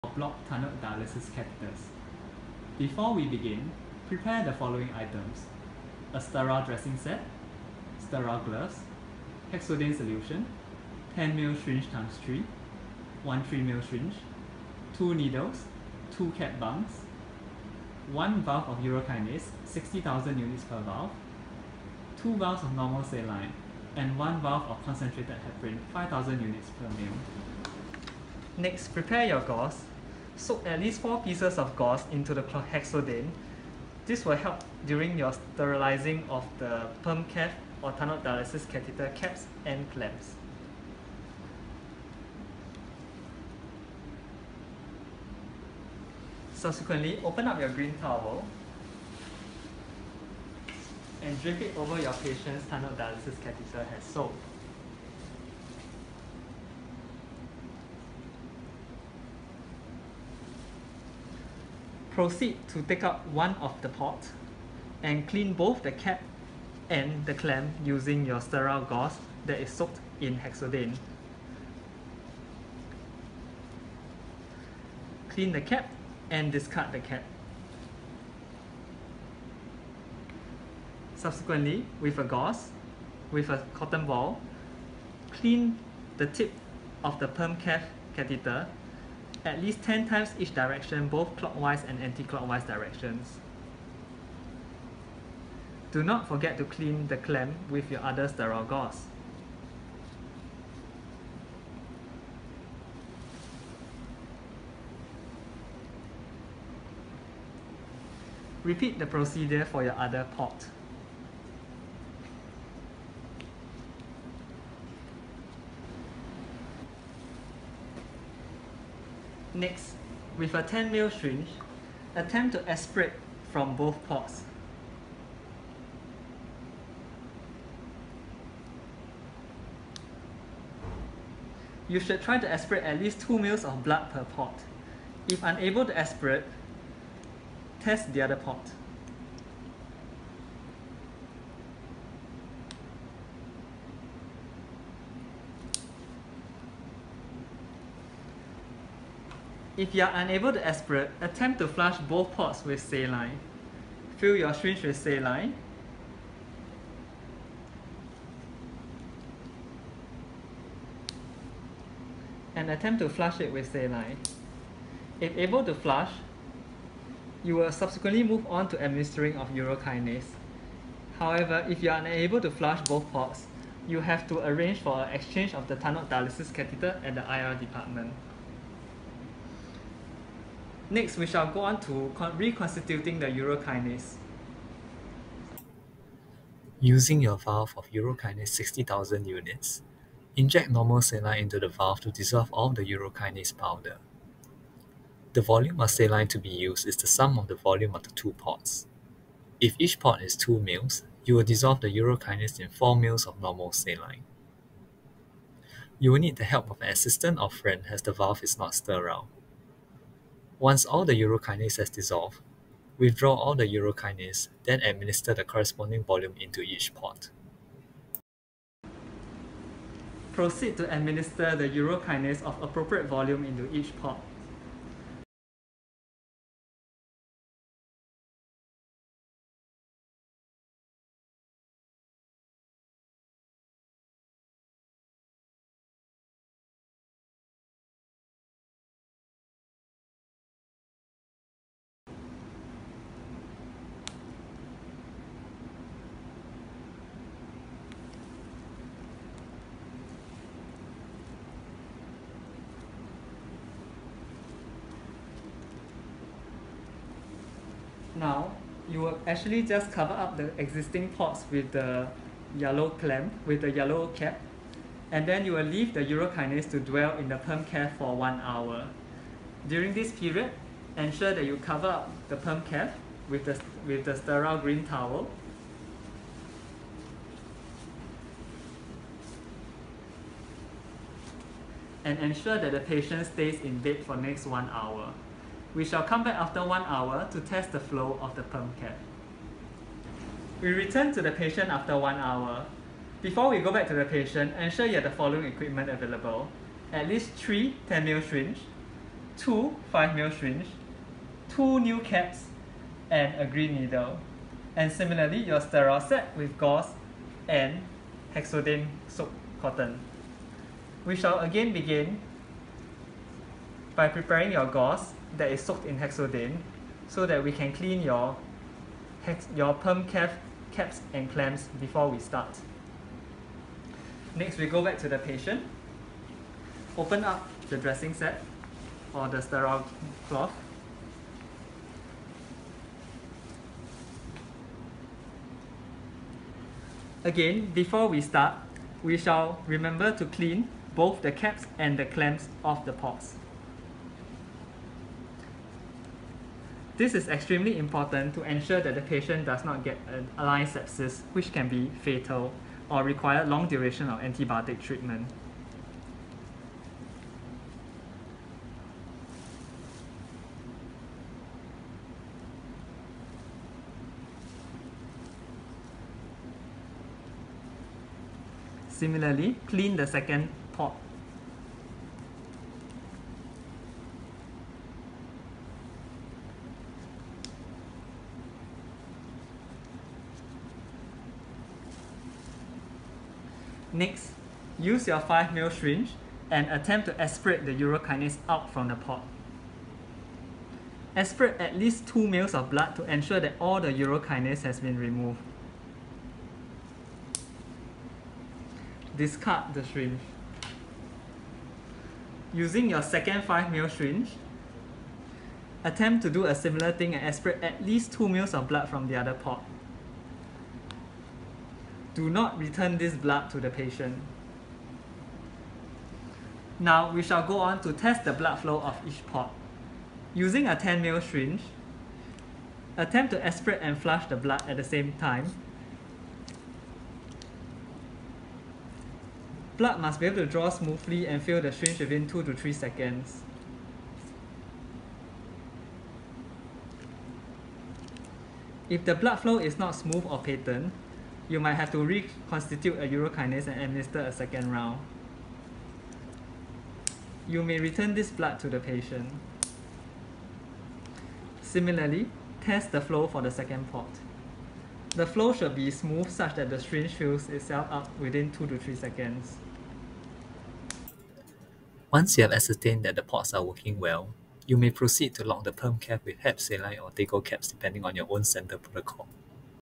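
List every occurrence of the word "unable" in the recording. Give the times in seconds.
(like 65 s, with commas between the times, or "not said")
135 s, 150 s, 171 s.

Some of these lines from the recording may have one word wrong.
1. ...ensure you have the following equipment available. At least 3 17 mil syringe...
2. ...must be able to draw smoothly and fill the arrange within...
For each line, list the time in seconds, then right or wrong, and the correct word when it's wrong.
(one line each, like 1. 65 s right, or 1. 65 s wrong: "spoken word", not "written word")
1. 294 s wrong: "10", not "17"
2. 429 s wrong: "syringe", not "arrange".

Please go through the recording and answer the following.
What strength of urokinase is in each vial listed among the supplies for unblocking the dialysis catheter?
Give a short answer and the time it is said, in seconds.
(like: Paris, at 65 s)
60,000 units, at 19 s.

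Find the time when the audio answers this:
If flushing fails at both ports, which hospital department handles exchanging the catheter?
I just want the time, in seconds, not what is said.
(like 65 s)
177 s.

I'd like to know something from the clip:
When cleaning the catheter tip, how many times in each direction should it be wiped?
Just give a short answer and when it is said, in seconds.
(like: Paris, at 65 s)
10 times, at 89 s.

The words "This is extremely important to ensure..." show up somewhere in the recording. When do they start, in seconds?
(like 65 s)
346 s.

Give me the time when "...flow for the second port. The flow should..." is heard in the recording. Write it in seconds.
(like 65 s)
453 s.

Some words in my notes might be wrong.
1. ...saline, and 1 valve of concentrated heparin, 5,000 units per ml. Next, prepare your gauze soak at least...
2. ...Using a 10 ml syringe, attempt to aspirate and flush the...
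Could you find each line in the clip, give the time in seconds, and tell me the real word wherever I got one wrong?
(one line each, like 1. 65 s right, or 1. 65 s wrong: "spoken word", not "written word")
1. 23 s right
2. 420 s right.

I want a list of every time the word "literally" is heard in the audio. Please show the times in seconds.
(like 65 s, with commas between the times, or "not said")
not said.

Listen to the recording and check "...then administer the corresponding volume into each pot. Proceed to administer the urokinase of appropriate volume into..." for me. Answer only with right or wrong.
right.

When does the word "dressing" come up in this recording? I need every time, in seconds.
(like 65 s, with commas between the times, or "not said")
6 s, 327 s.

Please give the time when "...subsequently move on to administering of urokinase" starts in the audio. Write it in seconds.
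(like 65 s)
167 s.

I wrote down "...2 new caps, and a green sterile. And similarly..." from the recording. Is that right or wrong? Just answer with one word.
wrong.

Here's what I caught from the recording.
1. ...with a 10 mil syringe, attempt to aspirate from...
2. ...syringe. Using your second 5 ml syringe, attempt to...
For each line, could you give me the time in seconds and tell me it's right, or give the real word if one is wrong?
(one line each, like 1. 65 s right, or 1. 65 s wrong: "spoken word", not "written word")
1. 120 s right
2. 399 s right.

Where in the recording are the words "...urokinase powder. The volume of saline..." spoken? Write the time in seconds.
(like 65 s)
192 s.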